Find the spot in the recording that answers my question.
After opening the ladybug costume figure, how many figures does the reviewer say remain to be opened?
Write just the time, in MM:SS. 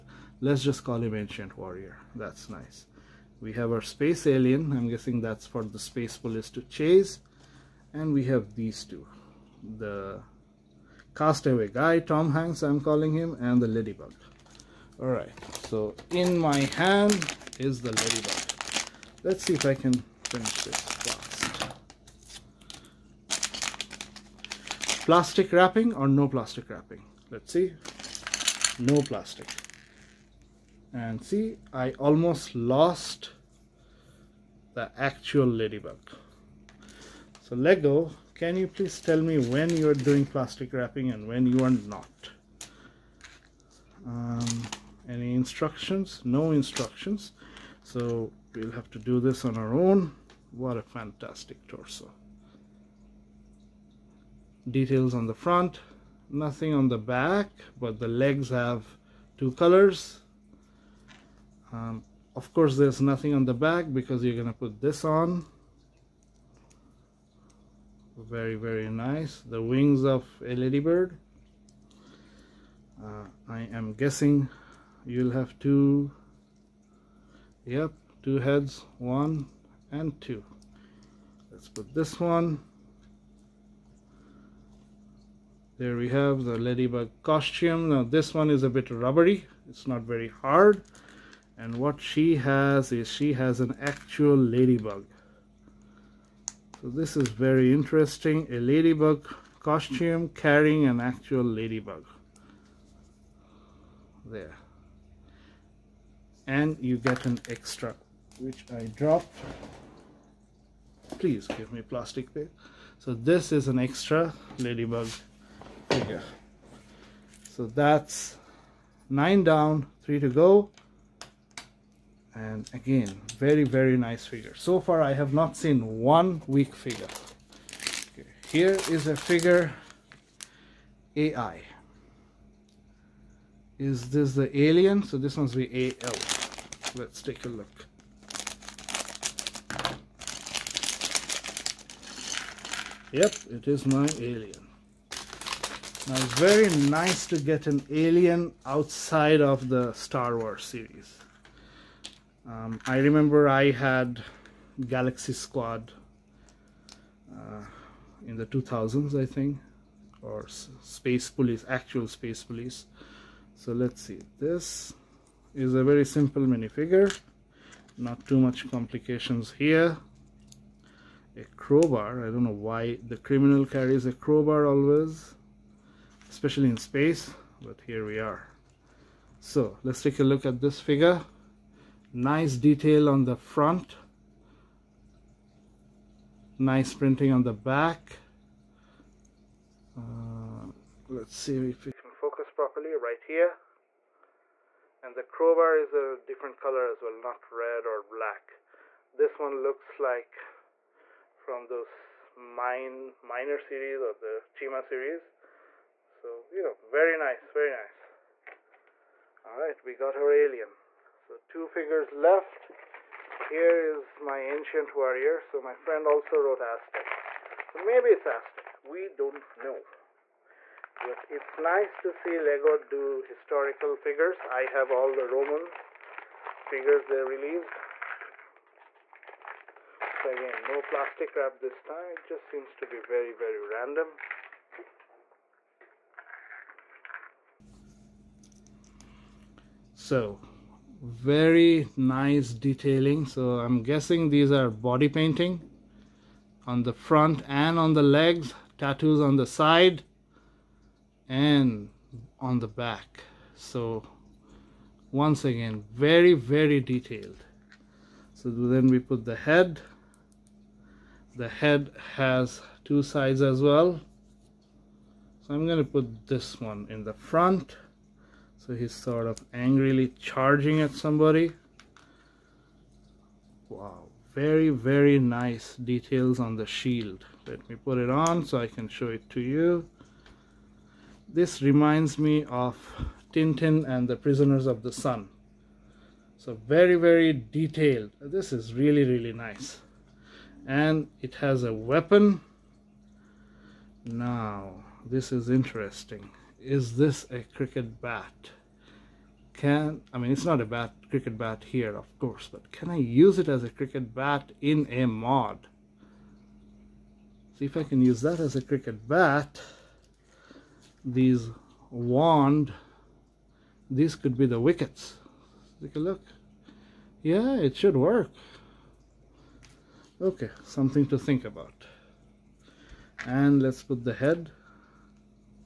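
02:00.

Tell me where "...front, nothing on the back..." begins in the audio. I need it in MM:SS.
00:55.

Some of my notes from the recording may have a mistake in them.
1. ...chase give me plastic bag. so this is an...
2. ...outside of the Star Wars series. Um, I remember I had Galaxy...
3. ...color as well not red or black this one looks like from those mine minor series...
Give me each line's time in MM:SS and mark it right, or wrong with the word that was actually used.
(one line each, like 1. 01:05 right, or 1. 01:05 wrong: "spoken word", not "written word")
1. 01:51 wrong: "please", not "chase"
2. 02:28 right
3. 03:16 right.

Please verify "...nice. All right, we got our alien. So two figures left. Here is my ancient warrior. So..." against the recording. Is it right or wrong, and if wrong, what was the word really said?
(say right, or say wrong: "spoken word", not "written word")
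right.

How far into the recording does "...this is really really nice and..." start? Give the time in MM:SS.
04:48.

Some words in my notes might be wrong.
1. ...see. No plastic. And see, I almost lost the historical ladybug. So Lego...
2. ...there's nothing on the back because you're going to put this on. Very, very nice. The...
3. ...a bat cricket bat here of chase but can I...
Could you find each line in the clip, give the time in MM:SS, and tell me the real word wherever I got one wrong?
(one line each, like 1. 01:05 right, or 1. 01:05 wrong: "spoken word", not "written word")
1. 00:27 wrong: "actual", not "historical"
2. 01:02 right
3. 05:00 wrong: "course", not "chase".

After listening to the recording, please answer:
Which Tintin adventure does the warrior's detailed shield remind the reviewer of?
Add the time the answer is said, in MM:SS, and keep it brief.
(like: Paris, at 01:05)
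Prisoners of the Sun, at 04:44.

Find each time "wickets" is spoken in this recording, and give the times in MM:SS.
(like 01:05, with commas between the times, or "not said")
05:14.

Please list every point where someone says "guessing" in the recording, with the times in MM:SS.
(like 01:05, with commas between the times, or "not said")
00:04, 01:13, 04:03.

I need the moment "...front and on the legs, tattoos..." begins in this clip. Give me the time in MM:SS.
04:06.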